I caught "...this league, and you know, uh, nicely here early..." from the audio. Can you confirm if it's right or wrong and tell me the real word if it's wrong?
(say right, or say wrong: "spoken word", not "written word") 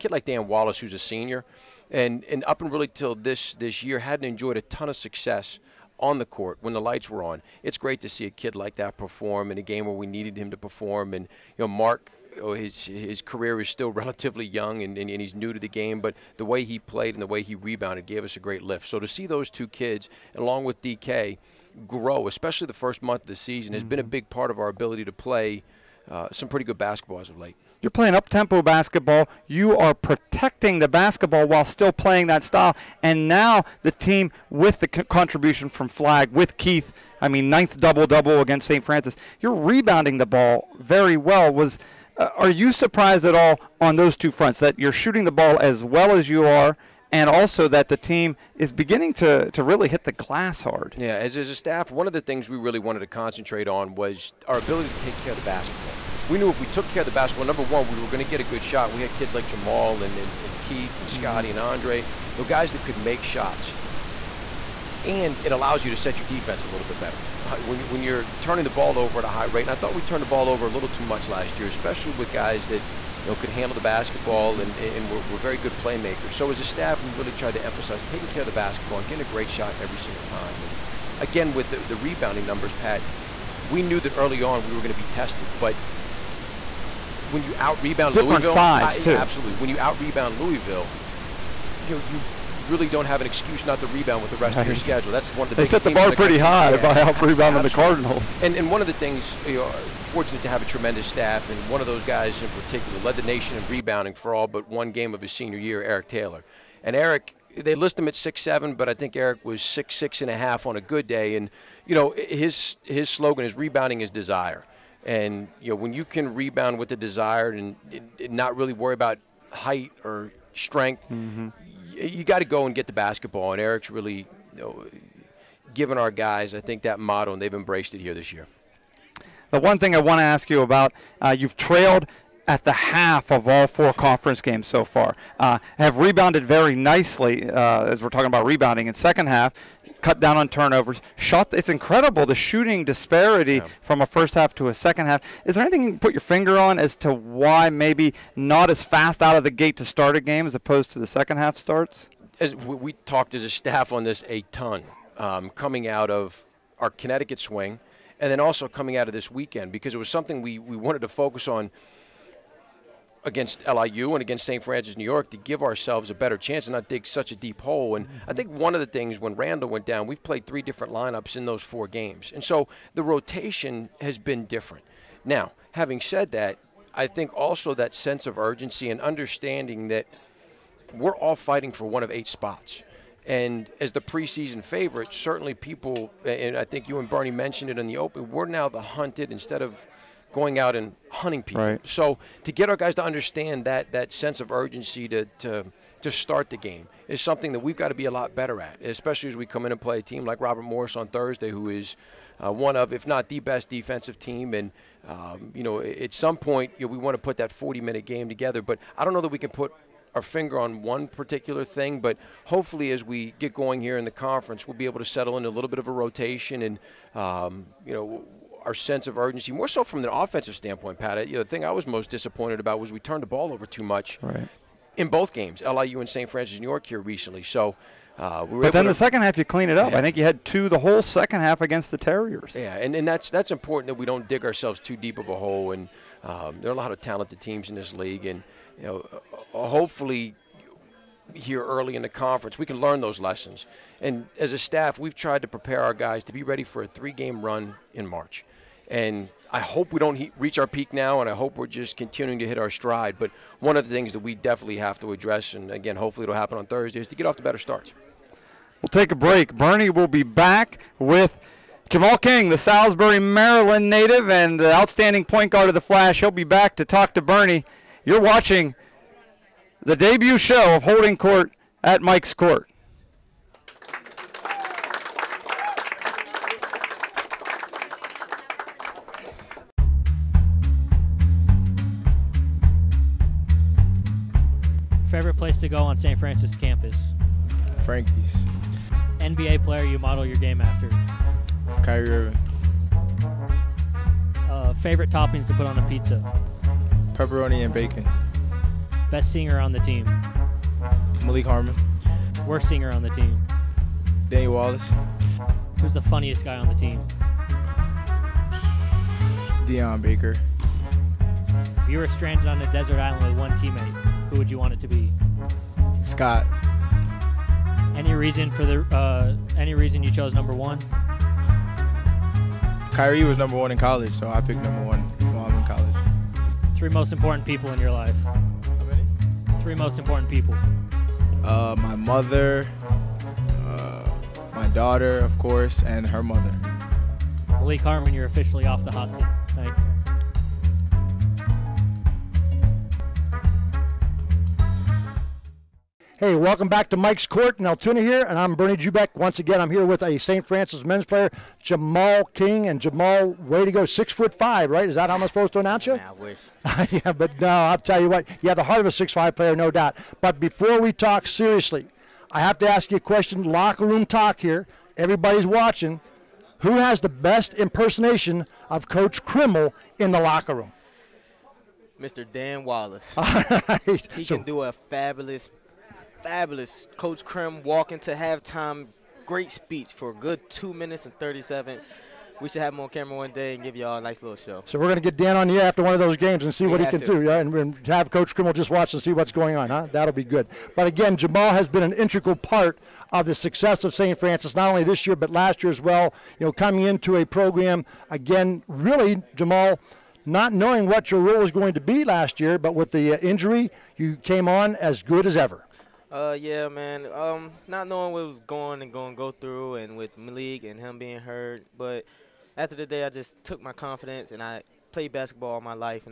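wrong: "hopefully", not "nicely".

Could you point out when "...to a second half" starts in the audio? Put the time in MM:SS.
02:24.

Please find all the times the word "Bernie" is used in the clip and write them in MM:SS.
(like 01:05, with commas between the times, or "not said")
03:07, 04:19, 04:27, 05:48.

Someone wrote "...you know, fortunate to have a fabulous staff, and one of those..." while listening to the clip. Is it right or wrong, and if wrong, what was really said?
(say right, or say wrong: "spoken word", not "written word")
wrong: "tremendous", not "fabulous".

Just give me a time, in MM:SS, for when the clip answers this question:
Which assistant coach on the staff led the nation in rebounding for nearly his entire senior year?
01:45.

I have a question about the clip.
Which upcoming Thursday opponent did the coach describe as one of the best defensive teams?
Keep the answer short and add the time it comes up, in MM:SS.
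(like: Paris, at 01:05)
Robert Morris, at 03:20.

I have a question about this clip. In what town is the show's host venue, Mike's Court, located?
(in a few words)
Altoona.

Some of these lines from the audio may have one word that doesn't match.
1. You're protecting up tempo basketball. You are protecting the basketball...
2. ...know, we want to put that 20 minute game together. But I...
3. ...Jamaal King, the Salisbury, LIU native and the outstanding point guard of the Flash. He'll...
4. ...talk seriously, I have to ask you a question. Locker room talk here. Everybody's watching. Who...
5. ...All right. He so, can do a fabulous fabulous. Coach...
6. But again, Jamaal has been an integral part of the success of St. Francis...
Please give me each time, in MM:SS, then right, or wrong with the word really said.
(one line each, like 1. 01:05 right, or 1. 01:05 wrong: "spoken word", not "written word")
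1. 00:27 wrong: "playing", not "protecting"
2. 03:26 wrong: "40", not "20"
3. 04:21 wrong: "Maryland", not "LIU"
4. 06:00 right
5. 06:13 right
6. 06:30 right.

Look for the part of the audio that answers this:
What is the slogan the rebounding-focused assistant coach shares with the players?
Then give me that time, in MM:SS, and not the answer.
01:53.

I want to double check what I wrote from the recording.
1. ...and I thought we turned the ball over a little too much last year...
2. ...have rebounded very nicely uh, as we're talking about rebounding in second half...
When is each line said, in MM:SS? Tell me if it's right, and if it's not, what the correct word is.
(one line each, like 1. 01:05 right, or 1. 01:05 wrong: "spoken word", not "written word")
1. 01:09 right
2. 02:15 right.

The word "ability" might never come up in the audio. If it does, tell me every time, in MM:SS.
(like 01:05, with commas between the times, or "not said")
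00:24, 00:54.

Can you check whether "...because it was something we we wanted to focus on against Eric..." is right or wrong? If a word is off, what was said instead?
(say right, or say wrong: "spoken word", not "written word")
wrong: "LIU", not "Eric".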